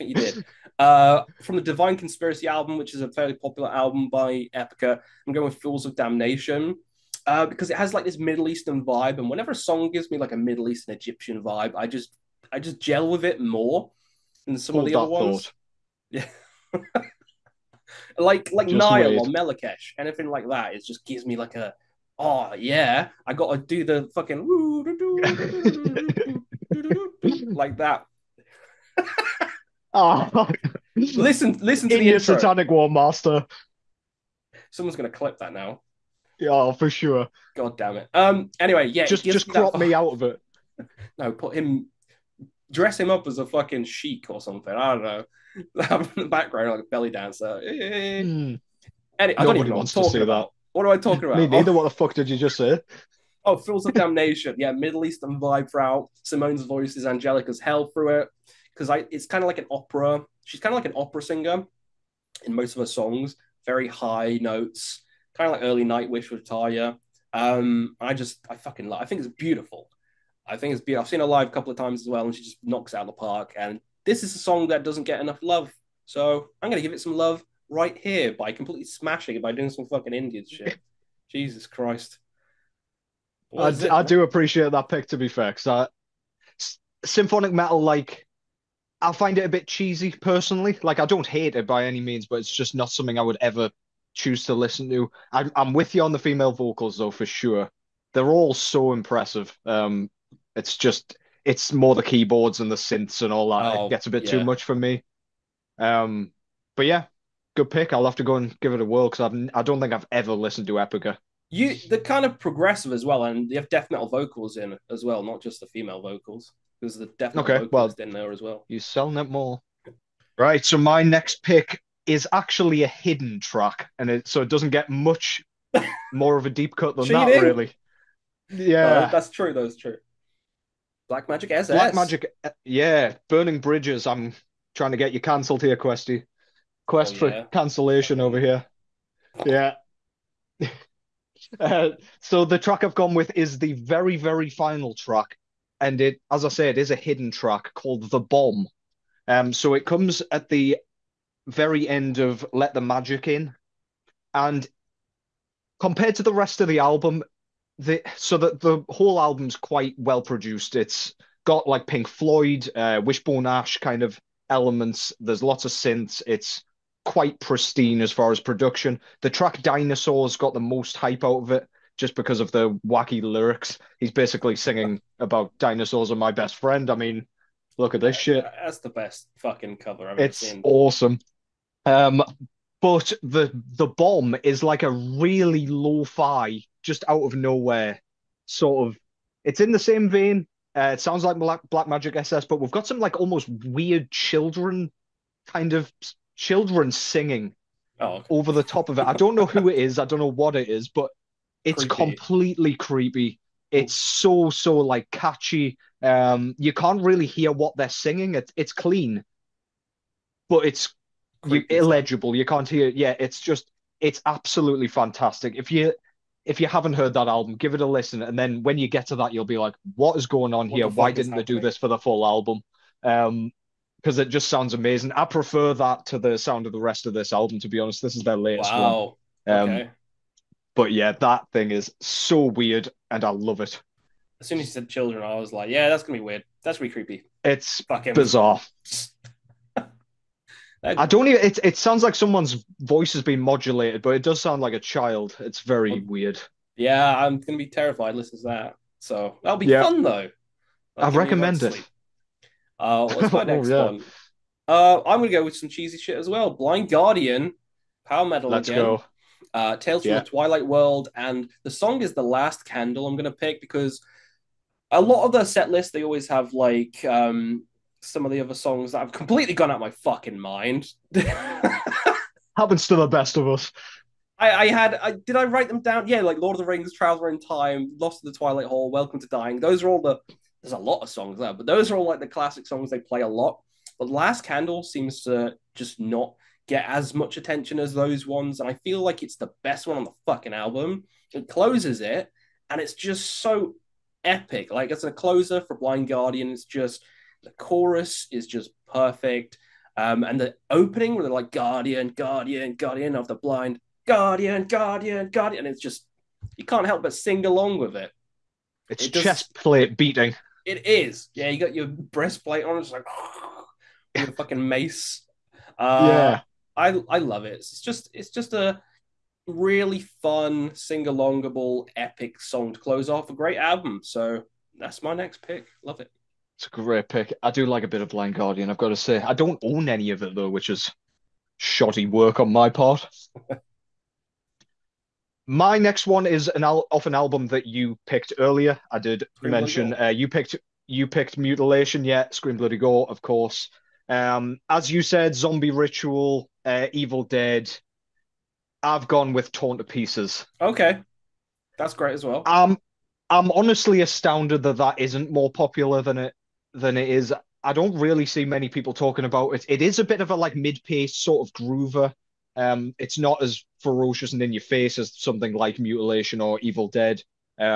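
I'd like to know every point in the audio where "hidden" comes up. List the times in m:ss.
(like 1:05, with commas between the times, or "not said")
2:02, 2:26.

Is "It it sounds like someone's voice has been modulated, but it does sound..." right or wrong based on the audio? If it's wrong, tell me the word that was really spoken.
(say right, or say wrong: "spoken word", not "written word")
right.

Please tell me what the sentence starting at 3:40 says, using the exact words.
Why didn't they do this for the full album?" Um, because it just sounds amazing.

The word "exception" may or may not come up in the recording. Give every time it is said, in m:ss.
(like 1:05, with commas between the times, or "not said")
not said.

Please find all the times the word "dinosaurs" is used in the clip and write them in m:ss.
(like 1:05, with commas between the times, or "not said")
2:49, 2:55.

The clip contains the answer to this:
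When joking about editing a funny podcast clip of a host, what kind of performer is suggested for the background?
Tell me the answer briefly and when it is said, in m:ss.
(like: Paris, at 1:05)
a belly dancer, at 0:46.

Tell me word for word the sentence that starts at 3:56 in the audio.
That's really creepy." It's fucking bizarre.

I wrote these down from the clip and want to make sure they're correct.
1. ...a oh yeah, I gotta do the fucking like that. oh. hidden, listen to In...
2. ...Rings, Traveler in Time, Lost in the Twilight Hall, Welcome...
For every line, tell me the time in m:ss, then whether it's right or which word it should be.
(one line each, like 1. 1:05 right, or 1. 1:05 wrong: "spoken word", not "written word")
1. 0:21 wrong: "listen", not "hidden"
2. 4:36 right.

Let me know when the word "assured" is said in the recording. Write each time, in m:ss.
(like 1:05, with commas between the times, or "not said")
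not said.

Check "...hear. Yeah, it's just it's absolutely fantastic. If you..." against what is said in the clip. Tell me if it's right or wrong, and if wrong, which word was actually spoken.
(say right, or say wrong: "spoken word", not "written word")
right.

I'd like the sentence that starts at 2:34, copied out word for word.
And compared to the rest of the album, the so that the whole album's quite well produced.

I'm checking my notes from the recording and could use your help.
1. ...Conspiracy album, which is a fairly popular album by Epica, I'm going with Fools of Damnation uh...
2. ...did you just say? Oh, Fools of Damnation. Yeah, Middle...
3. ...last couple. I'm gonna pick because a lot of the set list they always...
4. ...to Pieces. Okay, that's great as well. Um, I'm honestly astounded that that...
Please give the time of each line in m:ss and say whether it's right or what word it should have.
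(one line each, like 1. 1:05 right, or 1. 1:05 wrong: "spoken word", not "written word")
1. 0:01 right
2. 0:52 right
3. 4:22 wrong: "candle", not "couple"
4. 5:49 right.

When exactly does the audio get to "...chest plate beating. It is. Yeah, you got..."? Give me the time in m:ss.
5:09.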